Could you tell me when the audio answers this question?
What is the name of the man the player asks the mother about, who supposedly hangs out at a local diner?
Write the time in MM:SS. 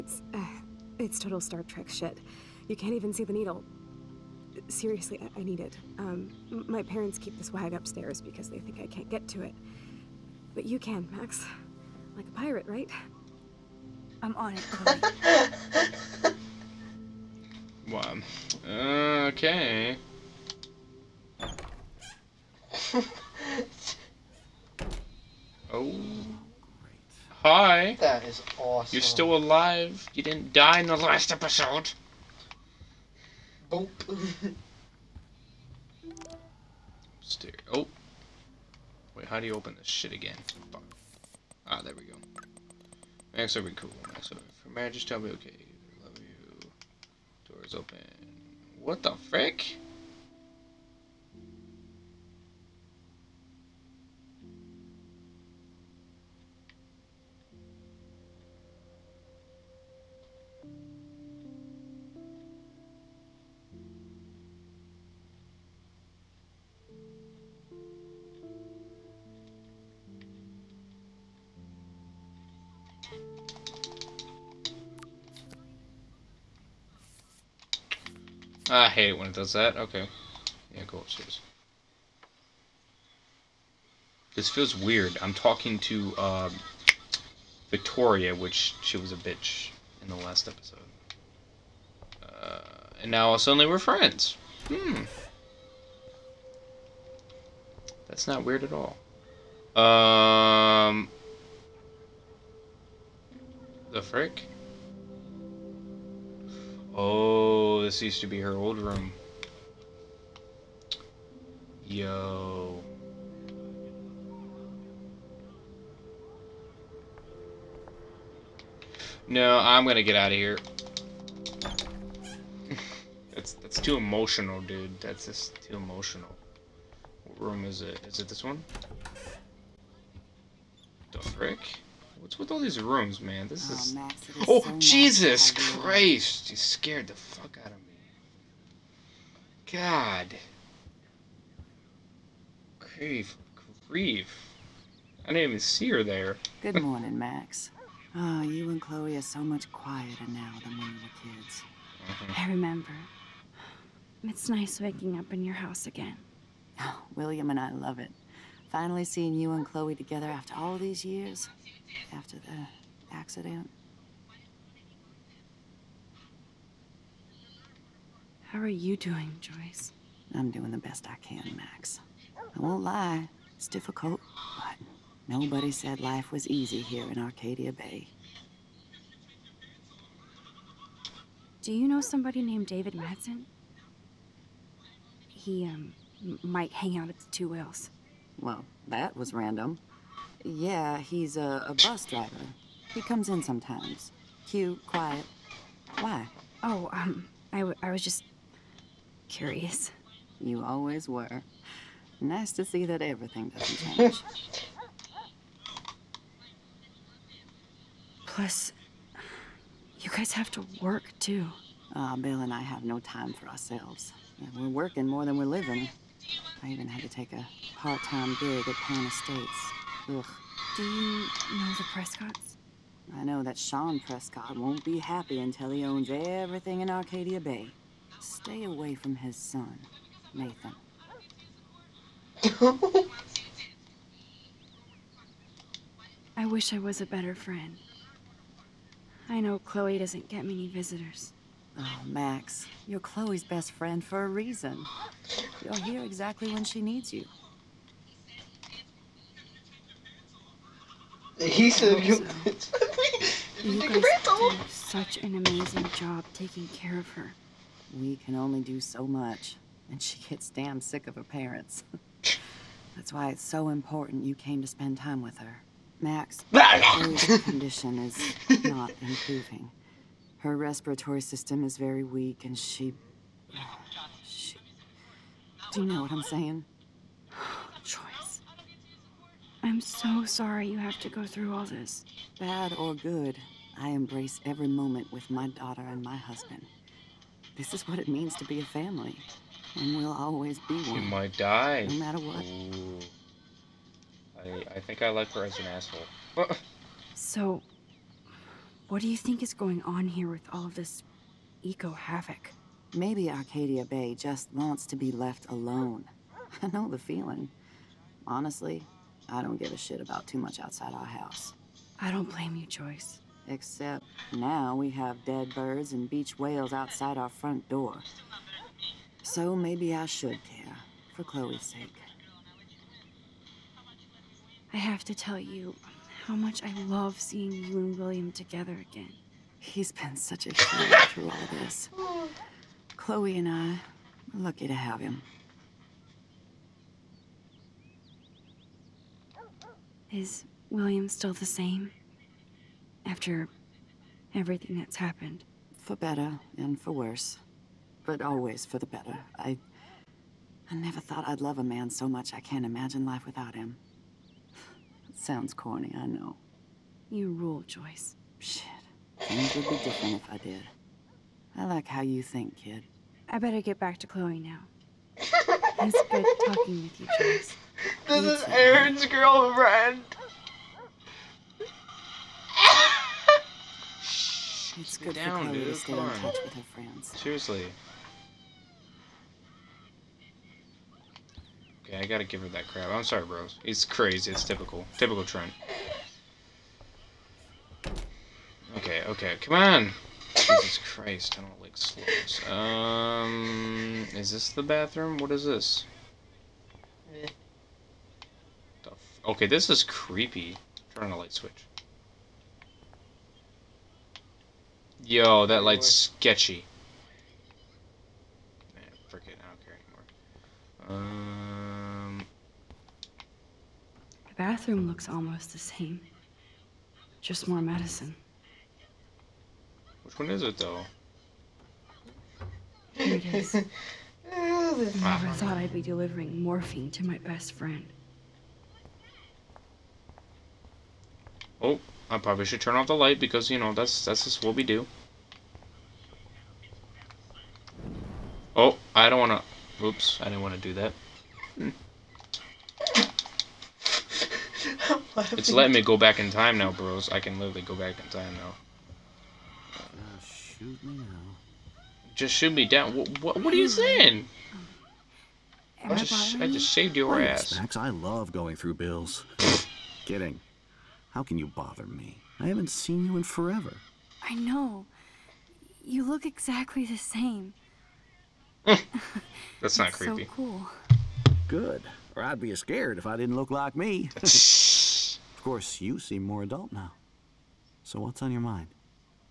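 03:02.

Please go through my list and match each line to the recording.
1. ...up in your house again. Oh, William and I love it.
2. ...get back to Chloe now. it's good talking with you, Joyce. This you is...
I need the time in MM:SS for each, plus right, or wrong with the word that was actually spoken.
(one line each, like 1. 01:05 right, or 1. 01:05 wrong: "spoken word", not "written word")
1. 02:35 right
2. 06:03 right.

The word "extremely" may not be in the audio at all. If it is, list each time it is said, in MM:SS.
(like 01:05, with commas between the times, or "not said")
not said.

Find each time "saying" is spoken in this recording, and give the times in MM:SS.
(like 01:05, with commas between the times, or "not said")
04:36, 07:33.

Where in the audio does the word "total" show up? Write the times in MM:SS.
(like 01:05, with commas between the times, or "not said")
00:01.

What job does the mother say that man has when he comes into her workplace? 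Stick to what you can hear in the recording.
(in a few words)
bus driver.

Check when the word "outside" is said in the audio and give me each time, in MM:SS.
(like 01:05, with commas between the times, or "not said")
05:10, 05:16.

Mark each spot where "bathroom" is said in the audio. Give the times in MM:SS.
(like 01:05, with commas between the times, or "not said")
06:34, 06:54.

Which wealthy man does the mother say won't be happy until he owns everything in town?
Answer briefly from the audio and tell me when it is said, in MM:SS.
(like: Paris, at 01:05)
Sean Prescott, at 03:43.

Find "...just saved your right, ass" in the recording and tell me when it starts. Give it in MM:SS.
07:36.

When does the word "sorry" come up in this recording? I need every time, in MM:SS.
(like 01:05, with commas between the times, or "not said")
04:40, 06:23.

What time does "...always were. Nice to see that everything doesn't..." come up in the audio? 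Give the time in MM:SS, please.
03:20.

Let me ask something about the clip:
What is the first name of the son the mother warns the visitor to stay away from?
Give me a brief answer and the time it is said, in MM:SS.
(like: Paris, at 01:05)
Nathan, at 03:50.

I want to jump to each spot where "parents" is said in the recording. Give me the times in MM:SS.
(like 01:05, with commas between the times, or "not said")
00:06, 04:21.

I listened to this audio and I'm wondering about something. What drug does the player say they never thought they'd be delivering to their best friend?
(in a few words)
morphine.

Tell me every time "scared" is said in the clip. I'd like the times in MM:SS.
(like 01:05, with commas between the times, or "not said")
02:16, 07:52.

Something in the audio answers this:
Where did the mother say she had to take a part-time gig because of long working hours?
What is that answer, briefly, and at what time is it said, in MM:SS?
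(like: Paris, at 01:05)
Pan Estates, at 03:38.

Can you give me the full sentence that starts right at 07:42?
I haven't seen you in forever.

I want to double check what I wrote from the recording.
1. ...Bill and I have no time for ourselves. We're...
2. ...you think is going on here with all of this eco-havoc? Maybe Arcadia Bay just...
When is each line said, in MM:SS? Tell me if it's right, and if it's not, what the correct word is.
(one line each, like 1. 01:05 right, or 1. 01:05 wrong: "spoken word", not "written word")
1. 03:32 right
2. 04:59 right.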